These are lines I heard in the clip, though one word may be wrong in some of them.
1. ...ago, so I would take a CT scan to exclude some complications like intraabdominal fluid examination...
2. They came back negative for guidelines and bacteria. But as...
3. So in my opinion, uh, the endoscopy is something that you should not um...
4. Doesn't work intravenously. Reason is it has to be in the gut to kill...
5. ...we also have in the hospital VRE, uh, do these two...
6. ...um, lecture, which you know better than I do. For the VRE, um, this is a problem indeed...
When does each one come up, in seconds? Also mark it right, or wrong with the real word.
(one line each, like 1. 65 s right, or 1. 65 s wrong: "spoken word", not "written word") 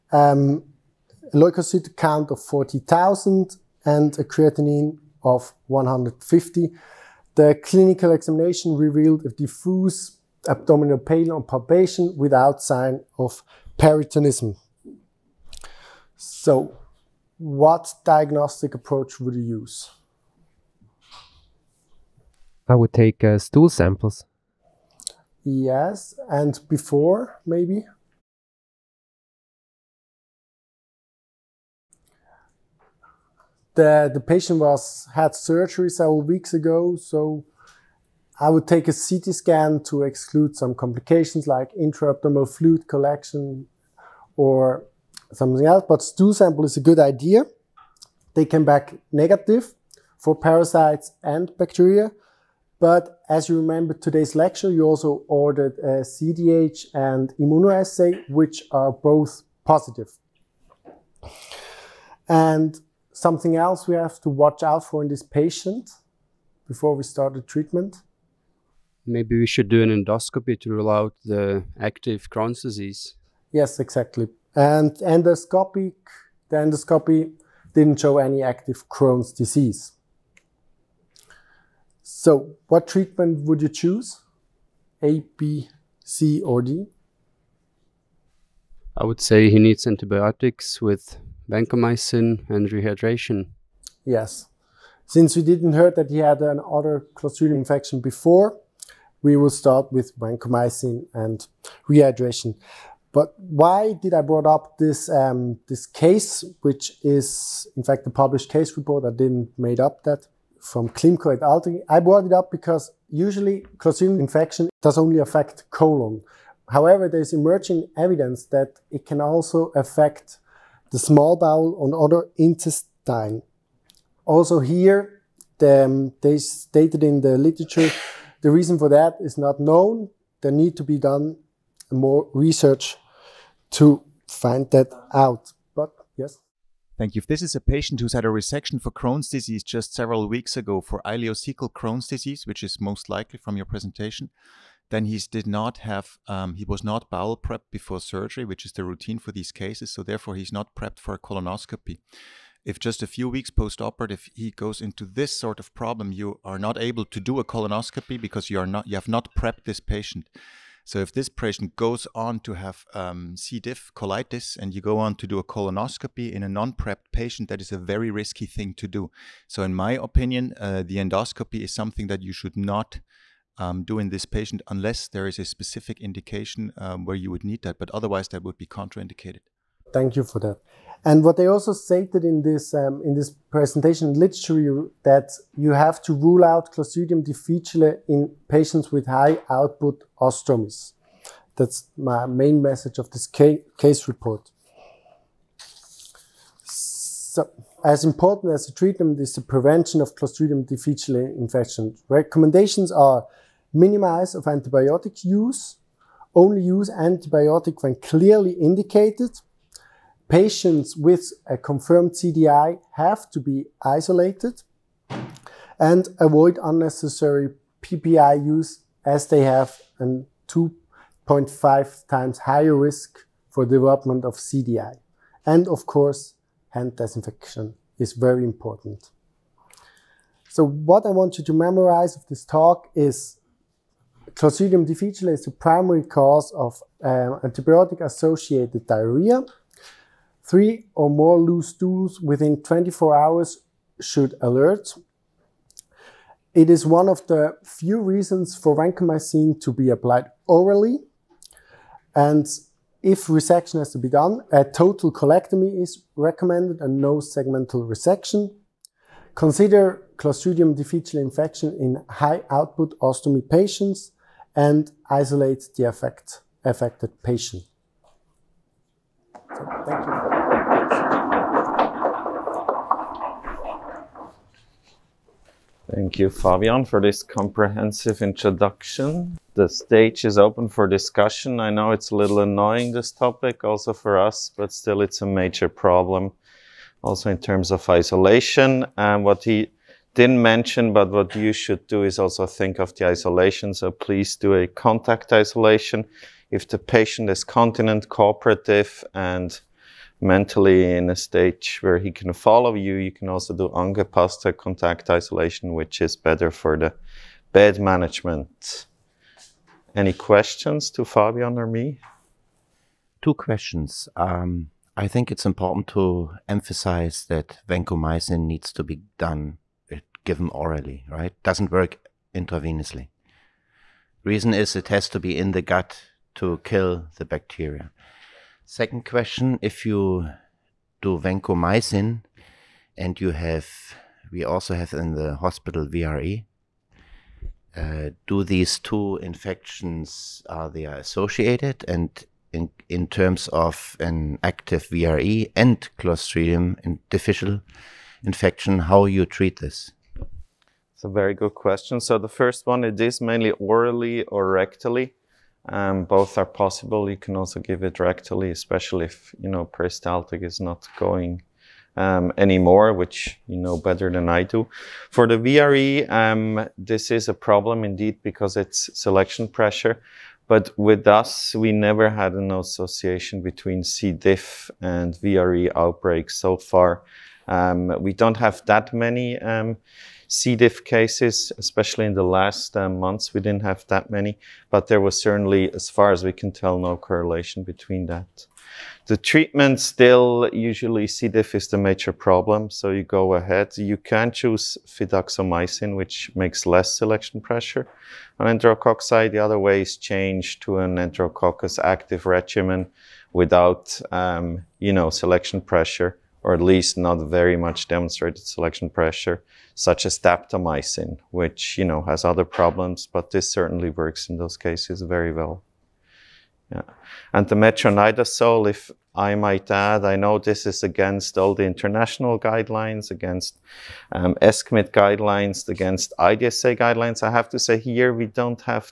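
1. 36 s wrong: "collection", not "examination"
2. 48 s wrong: "parasites", not "guidelines"
3. 169 s right
4. 321 s right
5. 334 s right
6. 361 s wrong: "anymore", not "lecture".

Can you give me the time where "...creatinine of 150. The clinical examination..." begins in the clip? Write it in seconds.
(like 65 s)
4 s.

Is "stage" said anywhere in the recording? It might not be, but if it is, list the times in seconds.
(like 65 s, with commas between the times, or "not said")
279 s, 301 s.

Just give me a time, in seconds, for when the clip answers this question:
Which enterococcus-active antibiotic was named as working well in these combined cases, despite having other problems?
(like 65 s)
410 s.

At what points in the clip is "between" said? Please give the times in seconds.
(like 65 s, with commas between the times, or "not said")
373 s, 387 s.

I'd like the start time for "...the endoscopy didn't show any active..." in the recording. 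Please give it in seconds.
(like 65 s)
76 s.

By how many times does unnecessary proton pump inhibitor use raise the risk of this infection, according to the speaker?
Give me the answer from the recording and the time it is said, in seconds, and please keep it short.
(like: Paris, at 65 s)
2.5 times, at 220 s.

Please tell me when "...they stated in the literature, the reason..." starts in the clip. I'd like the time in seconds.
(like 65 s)
126 s.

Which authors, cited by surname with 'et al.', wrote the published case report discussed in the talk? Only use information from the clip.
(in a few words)
Klimko et al.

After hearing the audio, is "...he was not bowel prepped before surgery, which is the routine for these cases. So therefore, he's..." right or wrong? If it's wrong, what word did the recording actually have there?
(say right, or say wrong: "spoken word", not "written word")
right.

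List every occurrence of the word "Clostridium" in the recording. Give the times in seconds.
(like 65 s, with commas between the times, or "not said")
97 s, 113 s, 186 s, 200 s, 234 s, 260 s, 345 s.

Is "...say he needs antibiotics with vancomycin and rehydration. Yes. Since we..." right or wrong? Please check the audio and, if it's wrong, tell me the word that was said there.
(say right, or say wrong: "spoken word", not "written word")
right.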